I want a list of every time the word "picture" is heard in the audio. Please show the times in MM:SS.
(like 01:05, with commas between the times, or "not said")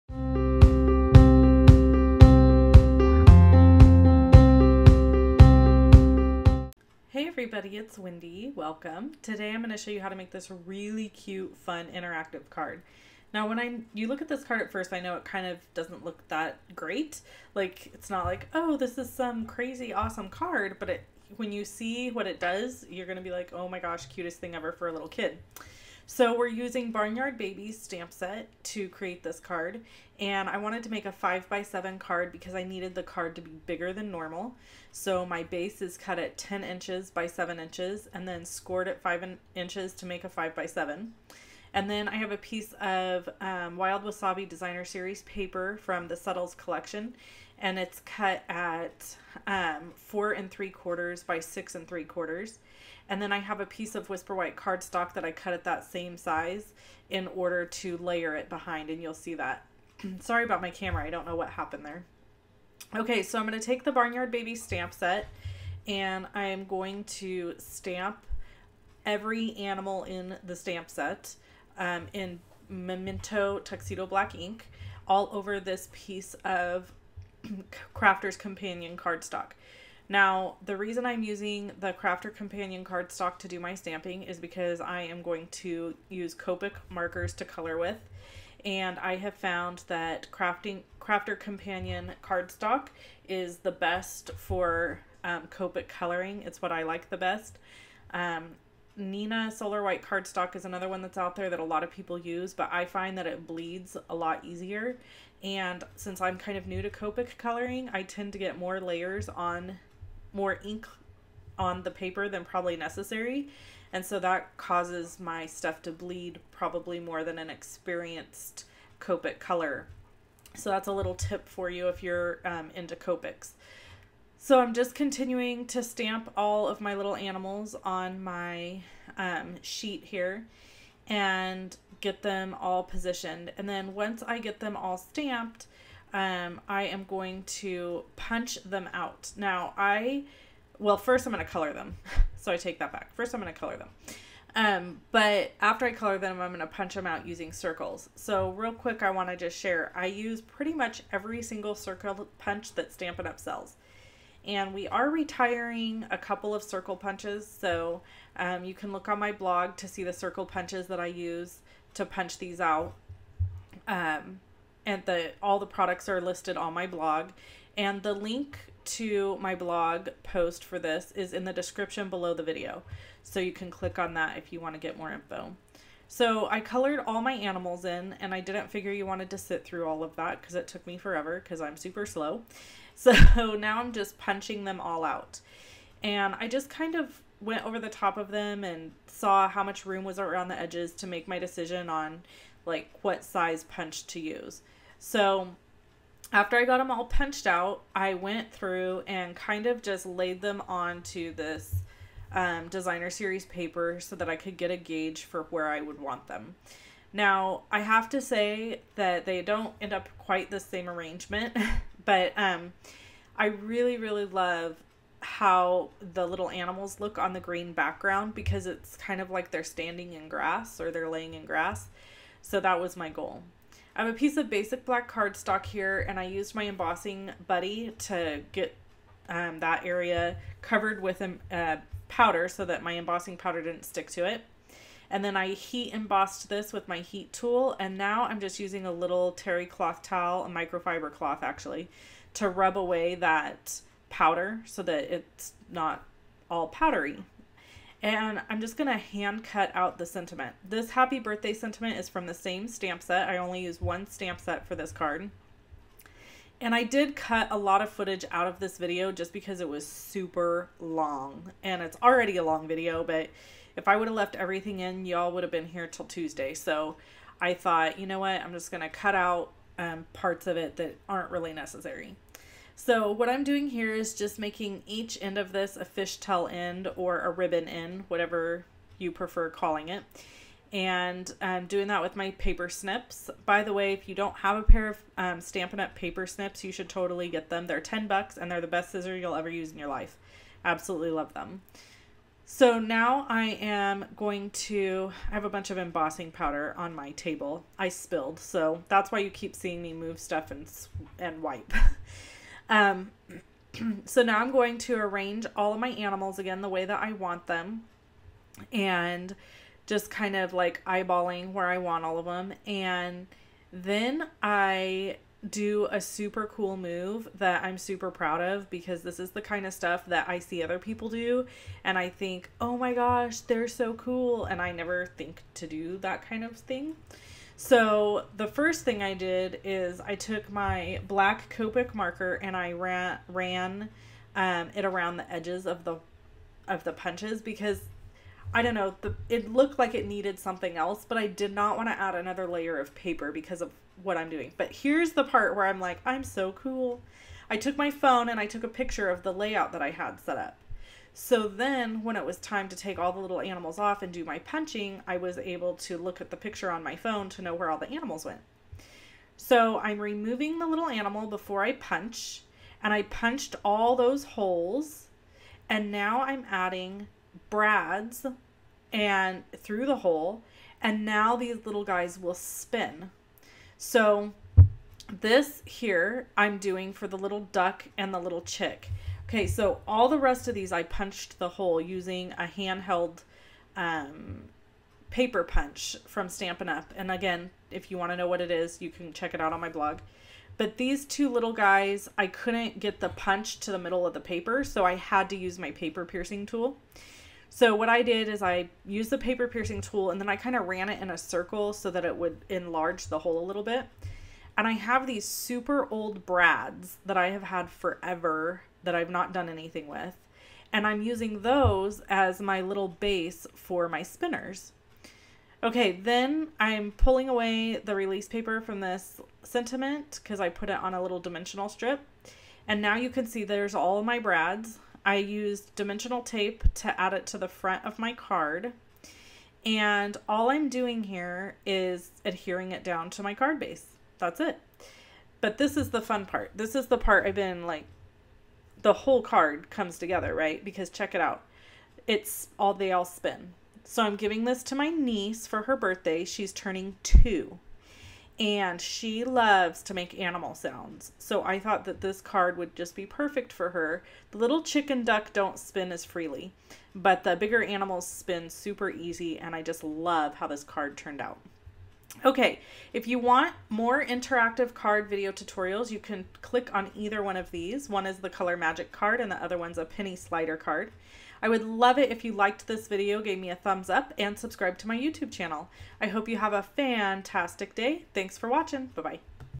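05:48, 05:56.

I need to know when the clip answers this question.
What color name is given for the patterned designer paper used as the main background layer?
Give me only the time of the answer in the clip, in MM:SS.
00:43.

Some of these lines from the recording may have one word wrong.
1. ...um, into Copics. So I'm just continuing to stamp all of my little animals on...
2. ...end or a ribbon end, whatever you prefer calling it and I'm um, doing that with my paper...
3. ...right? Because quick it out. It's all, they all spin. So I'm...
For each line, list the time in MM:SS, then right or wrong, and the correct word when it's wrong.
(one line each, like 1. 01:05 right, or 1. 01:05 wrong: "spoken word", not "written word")
1. 02:02 right
2. 04:36 right
3. 07:20 wrong: "check", not "quick".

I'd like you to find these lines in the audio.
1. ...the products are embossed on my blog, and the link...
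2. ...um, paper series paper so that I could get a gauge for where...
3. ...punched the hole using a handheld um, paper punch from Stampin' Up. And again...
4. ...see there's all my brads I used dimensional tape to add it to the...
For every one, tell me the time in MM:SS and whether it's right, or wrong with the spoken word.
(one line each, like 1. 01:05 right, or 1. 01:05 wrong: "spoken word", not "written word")
1. 02:45 wrong: "listed", not "embossed"
2. 03:22 wrong: "designer", not "paper"
3. 06:20 right
4. 07:03 right.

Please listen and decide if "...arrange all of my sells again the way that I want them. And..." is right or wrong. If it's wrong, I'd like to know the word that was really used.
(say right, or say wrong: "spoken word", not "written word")
wrong: "animals", not "sells".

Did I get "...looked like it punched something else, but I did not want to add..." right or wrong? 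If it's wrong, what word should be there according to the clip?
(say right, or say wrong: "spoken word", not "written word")
wrong: "needed", not "punched".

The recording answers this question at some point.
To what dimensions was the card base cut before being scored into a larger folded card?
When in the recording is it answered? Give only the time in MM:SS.
00:36.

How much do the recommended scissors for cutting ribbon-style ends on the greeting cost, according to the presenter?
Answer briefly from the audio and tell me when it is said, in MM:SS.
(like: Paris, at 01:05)
10 bucks, at 04:47.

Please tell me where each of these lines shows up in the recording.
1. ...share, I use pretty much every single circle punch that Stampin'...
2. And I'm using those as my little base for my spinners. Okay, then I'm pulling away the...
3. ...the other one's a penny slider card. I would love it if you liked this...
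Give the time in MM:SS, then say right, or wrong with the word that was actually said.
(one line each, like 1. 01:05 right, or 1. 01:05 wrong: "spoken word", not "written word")
1. 02:29 right
2. 06:50 right
3. 07:49 right.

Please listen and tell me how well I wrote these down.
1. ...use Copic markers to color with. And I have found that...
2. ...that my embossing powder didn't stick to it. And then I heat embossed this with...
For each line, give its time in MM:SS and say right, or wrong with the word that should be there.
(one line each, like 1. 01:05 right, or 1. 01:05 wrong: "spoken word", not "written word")
1. 01:26 right
2. 03:52 right.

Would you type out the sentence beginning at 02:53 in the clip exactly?
So you can click on that if you want to get more info.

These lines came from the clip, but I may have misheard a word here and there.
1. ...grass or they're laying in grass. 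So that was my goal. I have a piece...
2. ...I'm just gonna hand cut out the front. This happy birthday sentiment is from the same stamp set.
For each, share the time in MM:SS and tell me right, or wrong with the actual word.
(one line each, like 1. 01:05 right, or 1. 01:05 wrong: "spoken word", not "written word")
1. 03:40 right
2. 04:08 wrong: "sentiment", not "front".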